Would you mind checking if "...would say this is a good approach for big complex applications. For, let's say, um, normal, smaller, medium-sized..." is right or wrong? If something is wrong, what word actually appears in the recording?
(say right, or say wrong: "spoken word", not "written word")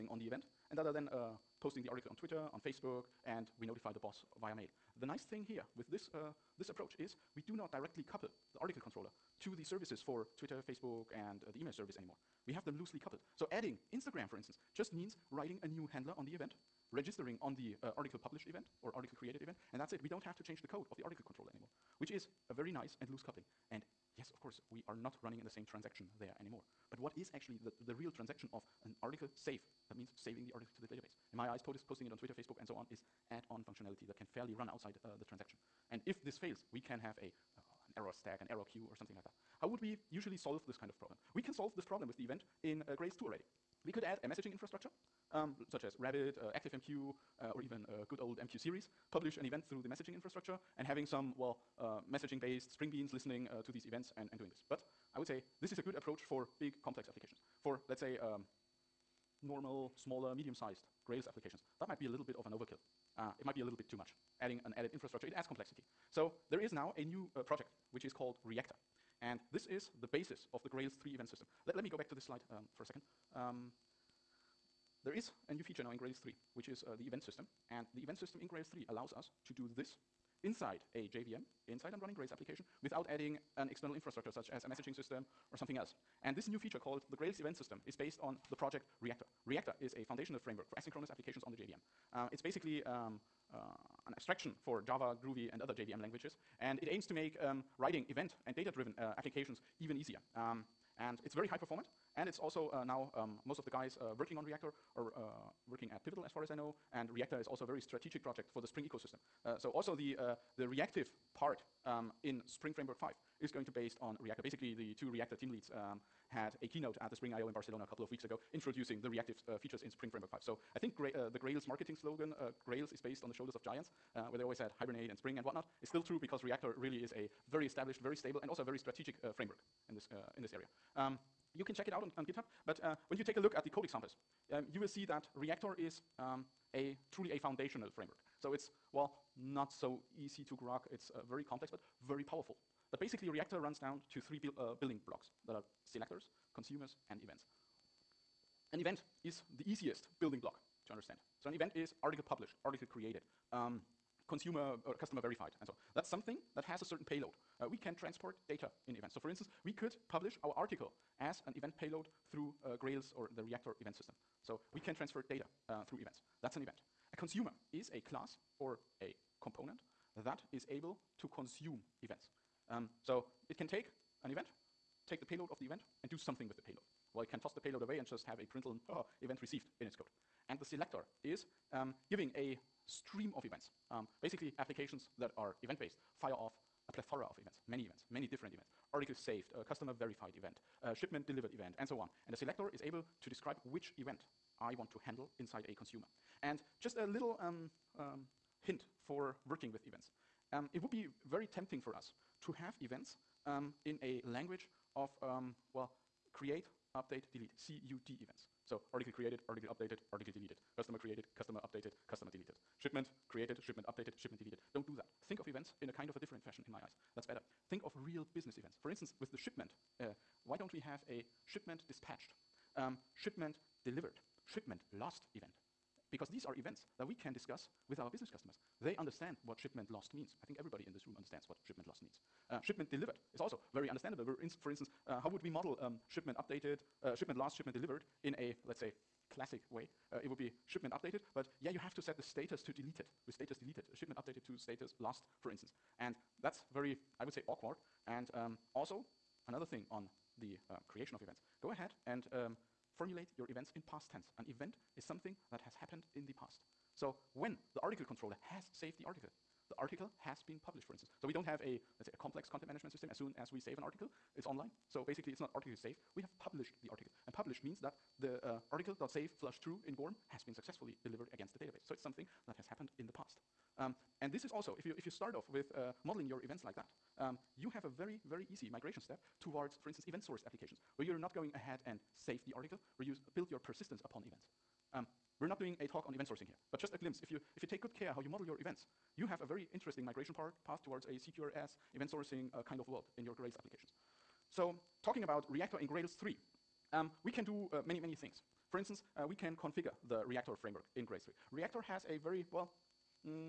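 right.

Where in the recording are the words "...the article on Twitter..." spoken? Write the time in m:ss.
0:01.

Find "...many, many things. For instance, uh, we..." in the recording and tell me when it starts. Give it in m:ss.
4:57.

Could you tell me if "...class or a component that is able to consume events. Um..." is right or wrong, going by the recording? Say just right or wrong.
right.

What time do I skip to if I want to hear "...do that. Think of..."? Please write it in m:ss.
3:34.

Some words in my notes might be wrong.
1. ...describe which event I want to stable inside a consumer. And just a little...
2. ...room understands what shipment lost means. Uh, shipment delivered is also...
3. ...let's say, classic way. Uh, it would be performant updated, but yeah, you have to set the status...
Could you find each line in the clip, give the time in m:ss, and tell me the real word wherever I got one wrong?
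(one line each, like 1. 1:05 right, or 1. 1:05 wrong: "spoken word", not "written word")
1. 3:13 wrong: "handle", not "stable"
2. 3:51 right
3. 3:58 wrong: "shipment", not "performant".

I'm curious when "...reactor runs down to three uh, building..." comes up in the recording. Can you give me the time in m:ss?
2:23.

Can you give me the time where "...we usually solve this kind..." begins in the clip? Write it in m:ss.
0:39.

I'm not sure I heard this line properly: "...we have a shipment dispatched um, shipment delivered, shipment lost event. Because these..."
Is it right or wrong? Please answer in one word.
right.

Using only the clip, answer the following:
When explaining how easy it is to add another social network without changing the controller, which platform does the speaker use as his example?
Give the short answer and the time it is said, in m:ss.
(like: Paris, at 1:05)
Instagram, at 0:13.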